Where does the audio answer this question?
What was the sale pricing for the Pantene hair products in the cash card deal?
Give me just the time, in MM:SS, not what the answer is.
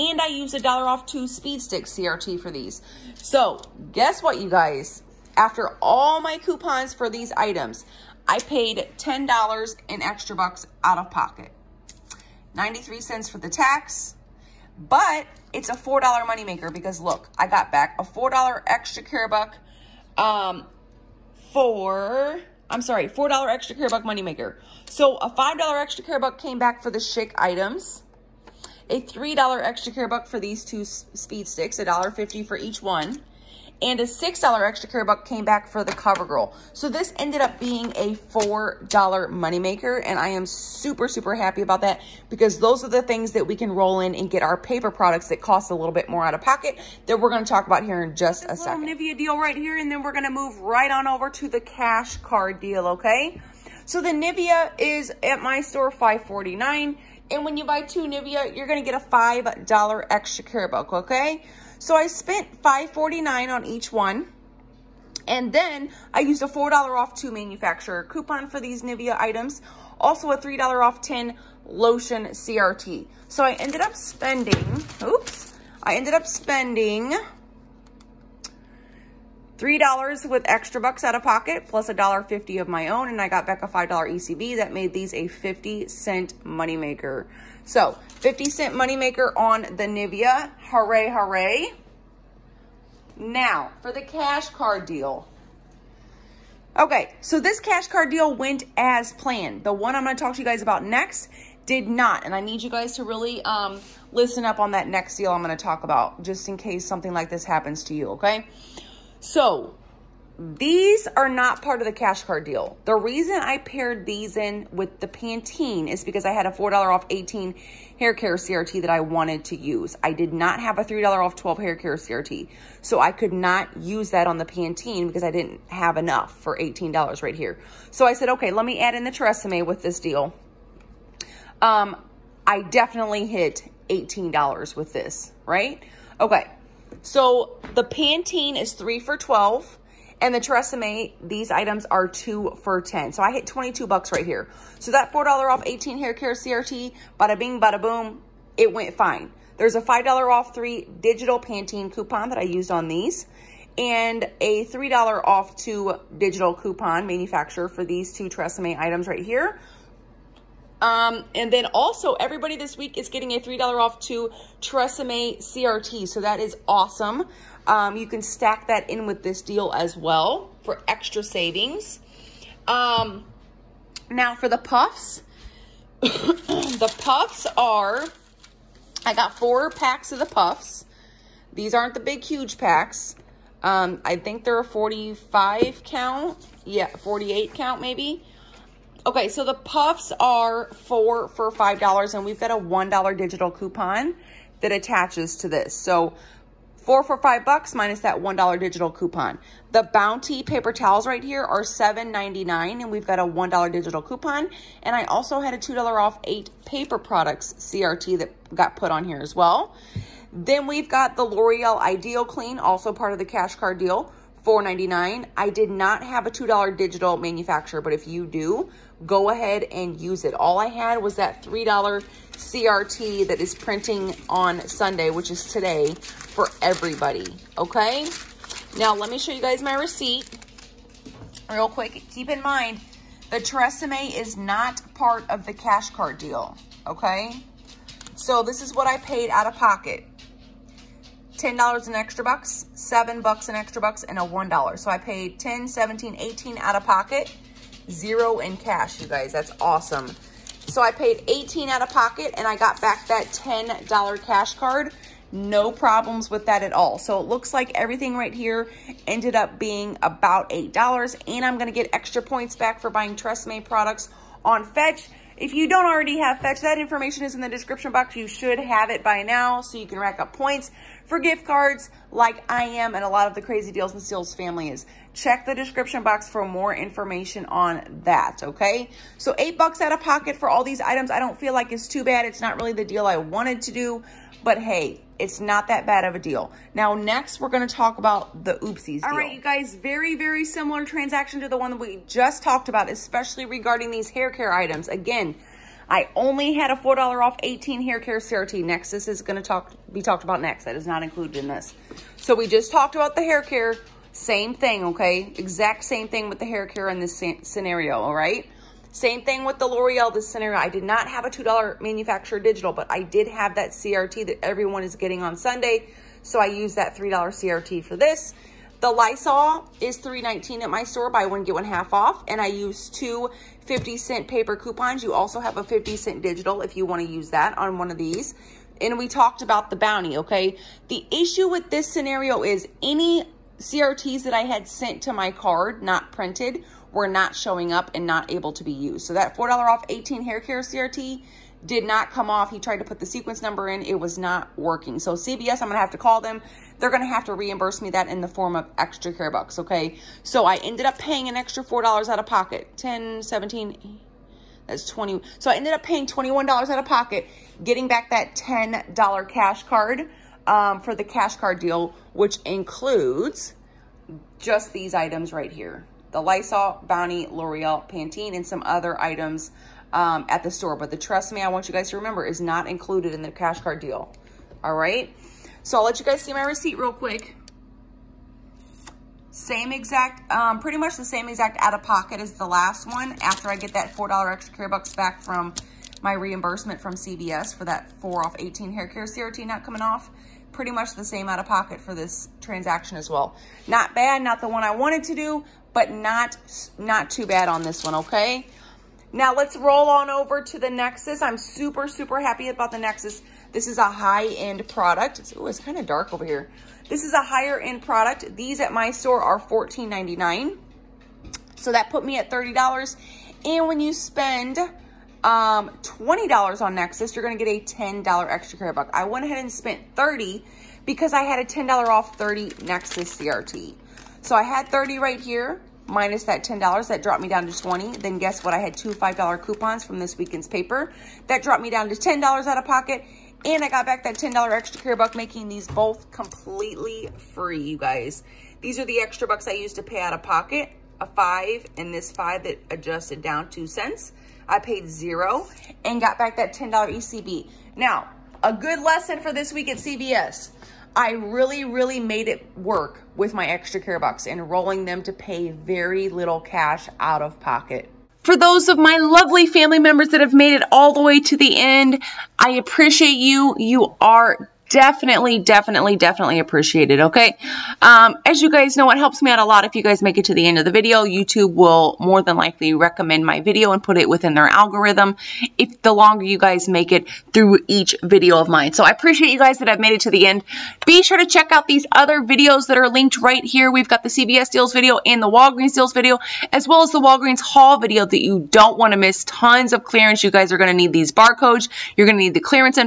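02:18.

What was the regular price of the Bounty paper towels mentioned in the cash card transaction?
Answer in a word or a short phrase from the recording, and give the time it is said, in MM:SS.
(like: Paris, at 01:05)
$7.99, at 03:21.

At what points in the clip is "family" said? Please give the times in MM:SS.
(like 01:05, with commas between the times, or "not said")
04:34, 07:39.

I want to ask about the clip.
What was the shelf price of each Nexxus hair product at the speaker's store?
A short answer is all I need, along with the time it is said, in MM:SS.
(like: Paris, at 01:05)
$14.99, at 06:49.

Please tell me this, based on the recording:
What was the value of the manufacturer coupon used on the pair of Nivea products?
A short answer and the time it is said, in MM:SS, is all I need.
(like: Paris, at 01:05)
$4 off 2, at 01:06.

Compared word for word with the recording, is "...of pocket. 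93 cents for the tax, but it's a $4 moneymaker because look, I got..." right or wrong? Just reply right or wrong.
right.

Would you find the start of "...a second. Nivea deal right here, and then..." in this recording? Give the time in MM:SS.
00:48.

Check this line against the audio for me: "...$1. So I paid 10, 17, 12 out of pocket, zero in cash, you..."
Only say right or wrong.
wrong.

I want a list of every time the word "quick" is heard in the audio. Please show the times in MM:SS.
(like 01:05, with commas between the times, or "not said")
03:51, 06:16.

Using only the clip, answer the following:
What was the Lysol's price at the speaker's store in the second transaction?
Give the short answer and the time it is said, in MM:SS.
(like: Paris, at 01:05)
$3.19, at 05:19.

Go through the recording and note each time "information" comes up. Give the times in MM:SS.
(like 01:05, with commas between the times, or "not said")
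04:26, 04:36.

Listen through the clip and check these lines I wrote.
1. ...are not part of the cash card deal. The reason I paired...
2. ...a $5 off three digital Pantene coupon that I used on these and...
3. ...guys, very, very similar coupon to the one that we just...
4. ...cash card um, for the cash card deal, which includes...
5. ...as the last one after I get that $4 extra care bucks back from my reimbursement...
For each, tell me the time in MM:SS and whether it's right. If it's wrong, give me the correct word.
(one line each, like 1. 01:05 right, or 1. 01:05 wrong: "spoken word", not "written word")
1. 01:51 right
2. 02:29 right
3. 04:49 wrong: "transaction", not "coupon"
4. 05:59 right
5. 06:22 right.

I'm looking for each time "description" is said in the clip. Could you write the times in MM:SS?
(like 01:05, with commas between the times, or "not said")
04:27, 04:35.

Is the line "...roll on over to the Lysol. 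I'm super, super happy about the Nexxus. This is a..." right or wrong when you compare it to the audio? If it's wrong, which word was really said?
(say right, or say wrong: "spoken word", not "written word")
wrong: "Nexxus", not "Lysol".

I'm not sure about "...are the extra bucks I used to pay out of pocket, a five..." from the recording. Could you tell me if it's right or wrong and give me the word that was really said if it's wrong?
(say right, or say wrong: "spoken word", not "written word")
right.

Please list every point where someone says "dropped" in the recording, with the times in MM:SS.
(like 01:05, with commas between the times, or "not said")
07:07, 07:11.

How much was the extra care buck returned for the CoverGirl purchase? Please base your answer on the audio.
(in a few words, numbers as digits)
$6.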